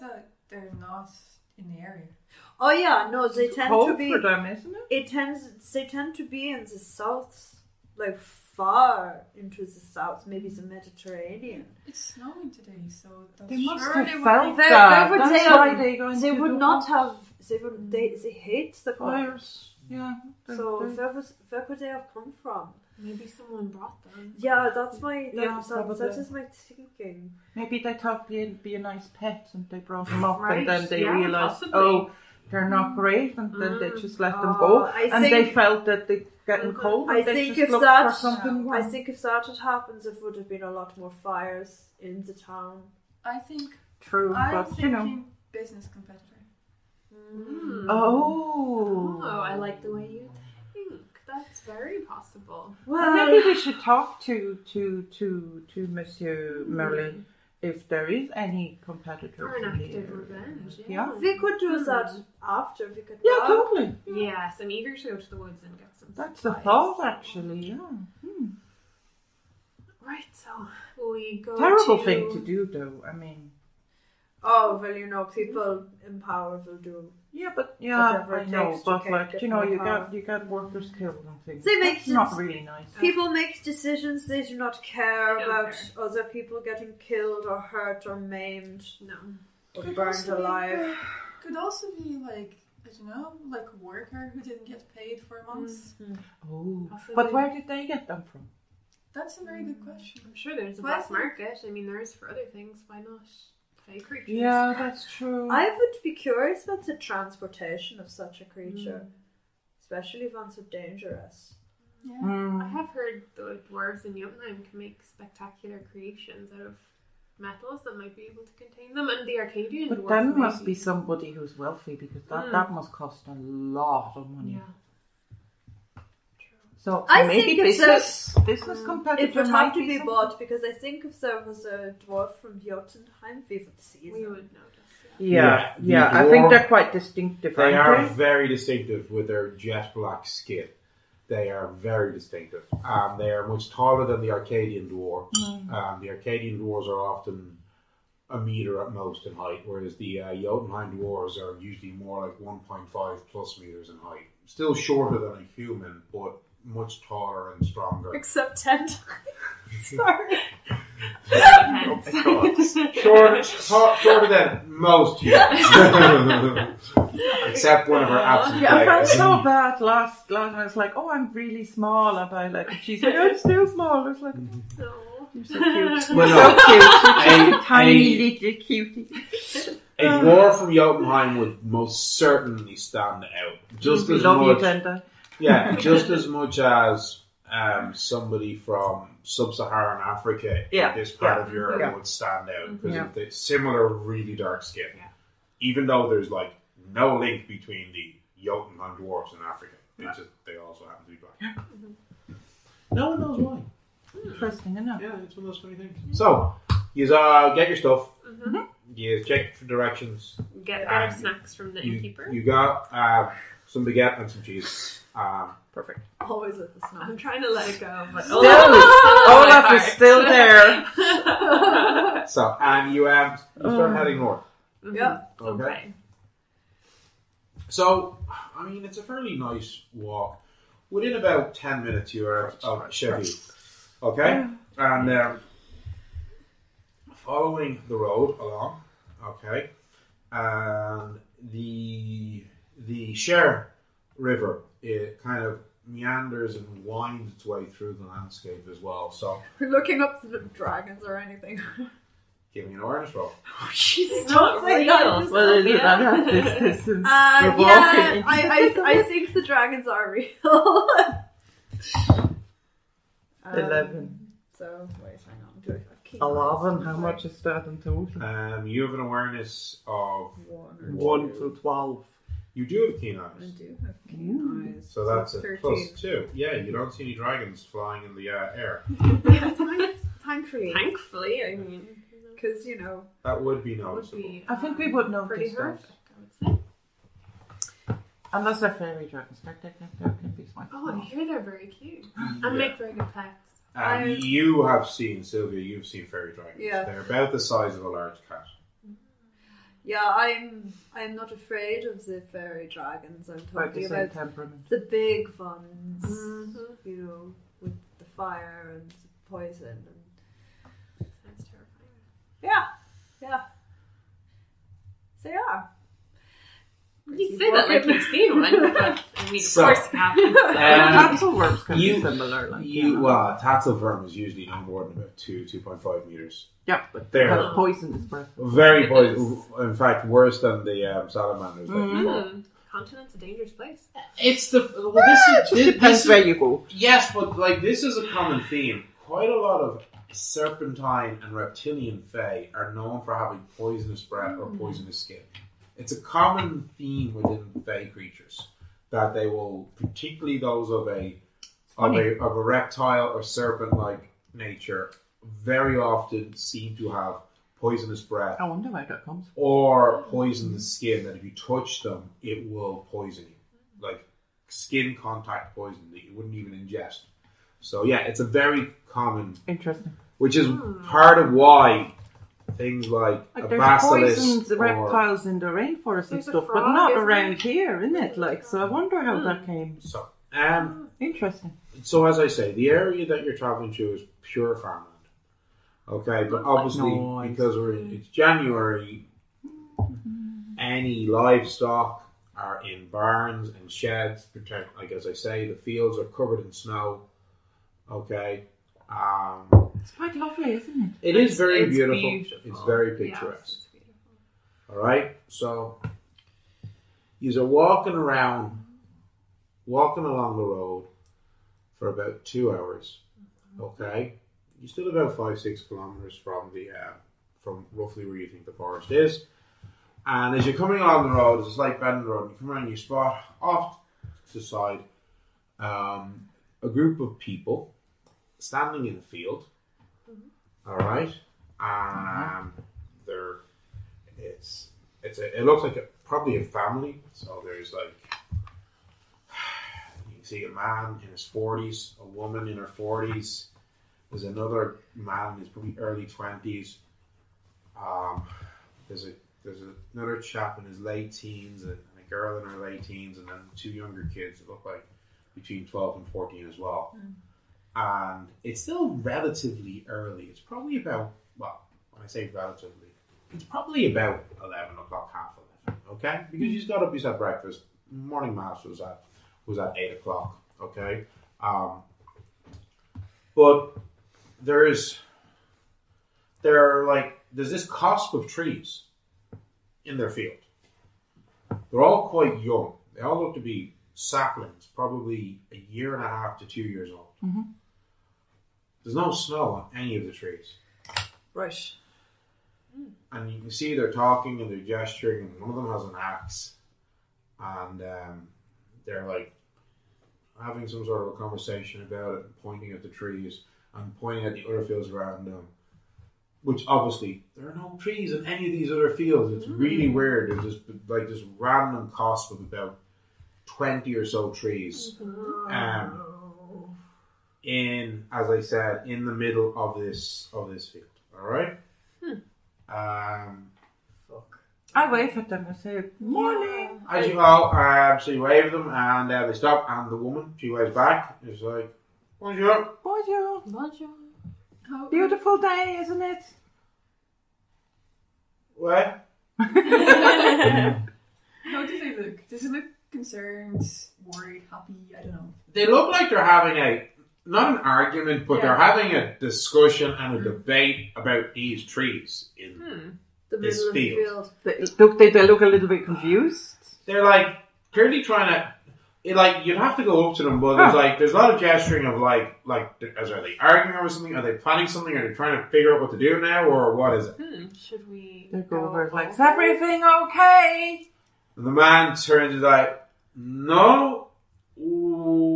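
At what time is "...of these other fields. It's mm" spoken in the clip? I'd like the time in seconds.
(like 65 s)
508 s.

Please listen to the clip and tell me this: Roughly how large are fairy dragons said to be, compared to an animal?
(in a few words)
a large cat.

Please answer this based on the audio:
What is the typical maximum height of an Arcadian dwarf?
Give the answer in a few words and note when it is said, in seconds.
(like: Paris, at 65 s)
1 meter, at 148 s.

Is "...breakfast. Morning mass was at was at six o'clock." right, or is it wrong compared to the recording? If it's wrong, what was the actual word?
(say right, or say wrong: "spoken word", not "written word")
wrong: "eight", not "six".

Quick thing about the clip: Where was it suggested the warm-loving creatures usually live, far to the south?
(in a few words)
the Mediterranean.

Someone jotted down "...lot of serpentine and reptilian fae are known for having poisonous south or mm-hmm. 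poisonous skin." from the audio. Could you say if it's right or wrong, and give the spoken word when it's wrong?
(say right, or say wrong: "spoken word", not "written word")
wrong: "breath", not "south".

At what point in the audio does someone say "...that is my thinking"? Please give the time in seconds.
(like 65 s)
25 s.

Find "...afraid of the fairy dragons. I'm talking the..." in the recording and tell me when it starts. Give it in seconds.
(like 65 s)
301 s.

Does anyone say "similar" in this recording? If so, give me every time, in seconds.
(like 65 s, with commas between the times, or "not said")
193 s, 322 s.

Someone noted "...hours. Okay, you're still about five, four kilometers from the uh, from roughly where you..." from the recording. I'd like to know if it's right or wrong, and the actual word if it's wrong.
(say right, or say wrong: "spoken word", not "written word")
wrong: "six", not "four".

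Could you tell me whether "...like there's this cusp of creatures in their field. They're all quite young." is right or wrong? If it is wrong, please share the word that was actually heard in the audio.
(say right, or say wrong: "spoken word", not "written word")
wrong: "trees", not "creatures".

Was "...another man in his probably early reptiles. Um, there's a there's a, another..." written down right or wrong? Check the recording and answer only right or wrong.
wrong.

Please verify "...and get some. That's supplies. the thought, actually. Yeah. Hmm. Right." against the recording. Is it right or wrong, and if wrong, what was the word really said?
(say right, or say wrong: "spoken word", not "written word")
right.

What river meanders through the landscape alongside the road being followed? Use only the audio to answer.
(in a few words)
Cher.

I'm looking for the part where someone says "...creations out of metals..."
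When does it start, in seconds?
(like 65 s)
115 s.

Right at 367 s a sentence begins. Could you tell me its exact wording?
So yeah, it's a very common interesting, which is part of why things like, like a there's basilisk.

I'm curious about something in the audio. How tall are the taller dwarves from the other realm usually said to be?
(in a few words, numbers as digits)
1.5 plus meters.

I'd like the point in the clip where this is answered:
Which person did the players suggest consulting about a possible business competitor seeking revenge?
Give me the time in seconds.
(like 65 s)
55 s.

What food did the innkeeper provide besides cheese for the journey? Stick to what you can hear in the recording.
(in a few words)
baguette.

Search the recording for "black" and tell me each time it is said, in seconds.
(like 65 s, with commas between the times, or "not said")
100 s, 139 s, 201 s.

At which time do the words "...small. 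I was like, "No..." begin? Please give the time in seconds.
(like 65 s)
173 s.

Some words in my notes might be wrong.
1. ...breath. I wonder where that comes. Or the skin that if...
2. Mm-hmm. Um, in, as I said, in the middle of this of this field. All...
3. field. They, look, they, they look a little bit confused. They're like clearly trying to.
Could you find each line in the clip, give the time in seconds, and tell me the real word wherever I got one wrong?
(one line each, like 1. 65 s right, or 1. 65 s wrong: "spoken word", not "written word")
1. 358 s right
2. 515 s right
3. 553 s right.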